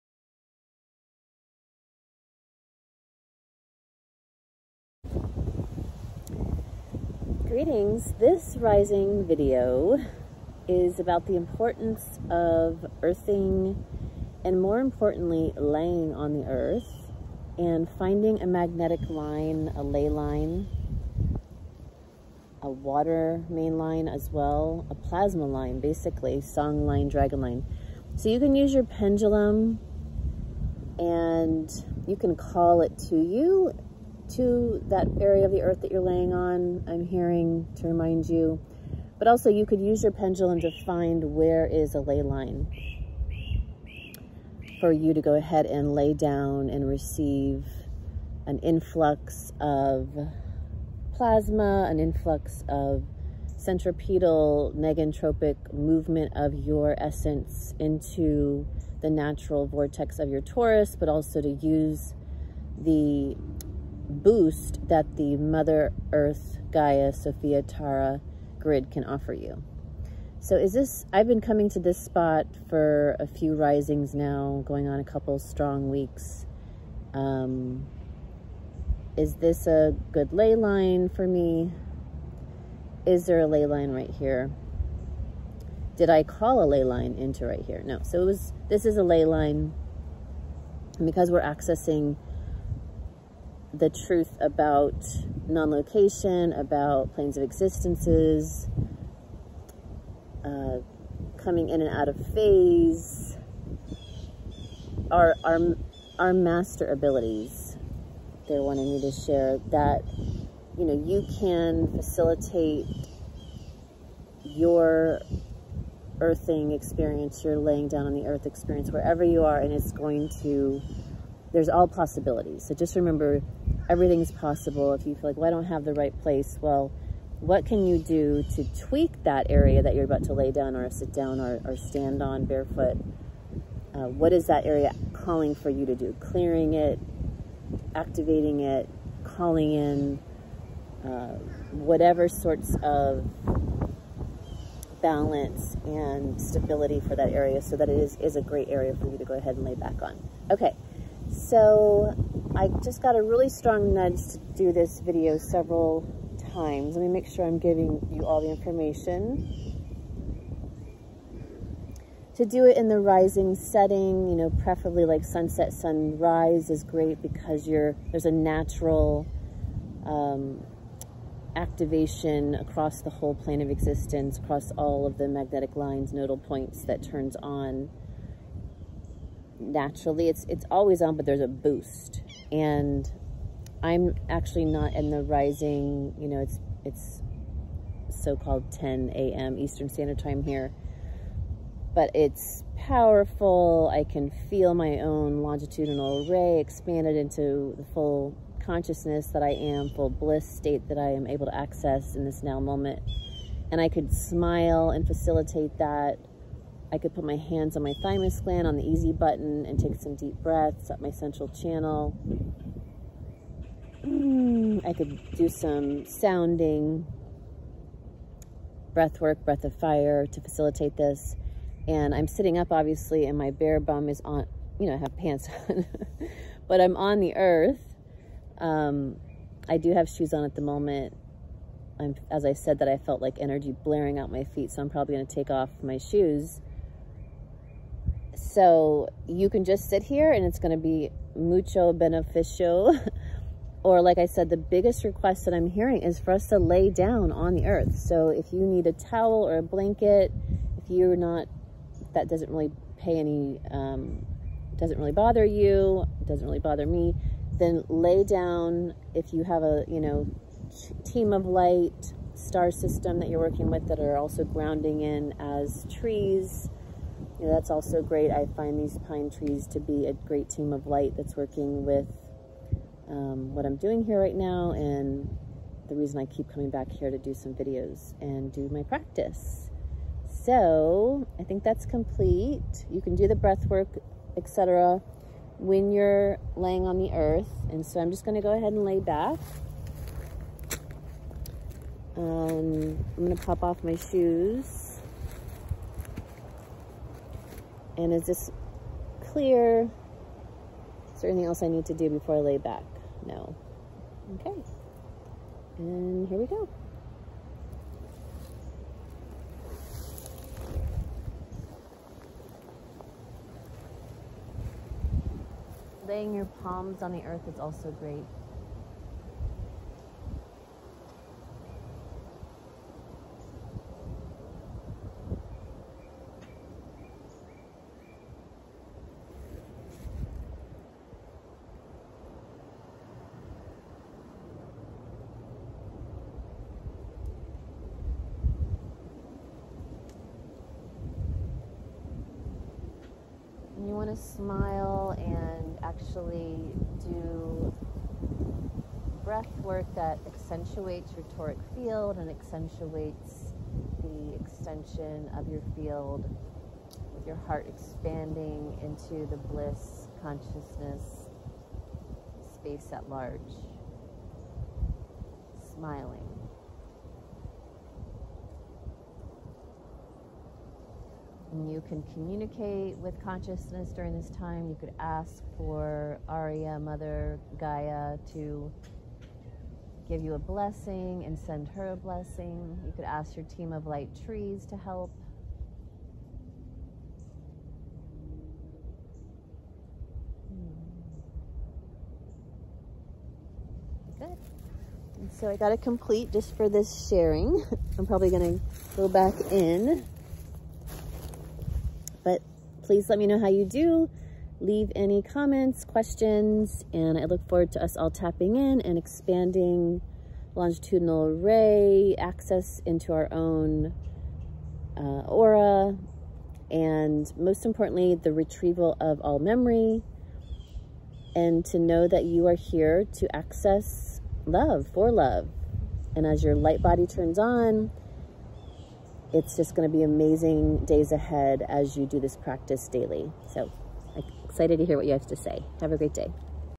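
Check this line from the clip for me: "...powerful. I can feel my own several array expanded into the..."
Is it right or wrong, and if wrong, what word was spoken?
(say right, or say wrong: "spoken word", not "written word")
wrong: "longitudinal", not "several".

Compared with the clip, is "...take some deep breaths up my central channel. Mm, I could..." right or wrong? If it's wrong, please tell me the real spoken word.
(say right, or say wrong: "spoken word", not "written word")
right.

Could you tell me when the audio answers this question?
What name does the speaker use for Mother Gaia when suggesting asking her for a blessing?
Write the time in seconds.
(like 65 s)
376 s.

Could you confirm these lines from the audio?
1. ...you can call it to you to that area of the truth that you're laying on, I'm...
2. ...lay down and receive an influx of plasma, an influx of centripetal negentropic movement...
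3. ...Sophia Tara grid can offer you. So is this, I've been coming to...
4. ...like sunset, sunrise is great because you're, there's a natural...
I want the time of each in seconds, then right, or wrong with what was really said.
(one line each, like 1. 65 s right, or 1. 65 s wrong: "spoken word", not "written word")
1. 32 s wrong: "earth", not "truth"
2. 45 s right
3. 67 s right
4. 165 s right.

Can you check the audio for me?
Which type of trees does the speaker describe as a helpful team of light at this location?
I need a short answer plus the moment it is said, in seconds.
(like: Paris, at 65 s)
pine trees, at 269 s.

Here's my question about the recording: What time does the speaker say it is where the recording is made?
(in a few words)
10 a.m. Eastern Standard Time.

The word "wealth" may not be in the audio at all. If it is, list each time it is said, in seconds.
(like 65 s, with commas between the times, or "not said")
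not said.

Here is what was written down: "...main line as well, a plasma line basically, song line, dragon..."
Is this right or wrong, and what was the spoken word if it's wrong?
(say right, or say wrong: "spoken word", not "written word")
right.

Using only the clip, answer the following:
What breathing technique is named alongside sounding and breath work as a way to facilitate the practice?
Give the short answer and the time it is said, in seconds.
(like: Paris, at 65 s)
breath of fire, at 219 s.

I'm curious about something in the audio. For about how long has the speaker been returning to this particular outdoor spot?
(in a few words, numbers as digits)
a couple strong weeks.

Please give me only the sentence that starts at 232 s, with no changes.
I'm, as I said that I felt like energy blaring out my feet.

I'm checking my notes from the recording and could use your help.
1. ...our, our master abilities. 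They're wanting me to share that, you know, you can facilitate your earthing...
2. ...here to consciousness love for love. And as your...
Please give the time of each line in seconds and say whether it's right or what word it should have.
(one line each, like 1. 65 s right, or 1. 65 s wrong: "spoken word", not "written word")
1. 105 s right
2. 422 s wrong: "access", not "consciousness".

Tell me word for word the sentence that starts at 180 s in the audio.
It's, it's always on, but there's a boost.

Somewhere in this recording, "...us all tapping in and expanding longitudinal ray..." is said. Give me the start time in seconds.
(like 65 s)
407 s.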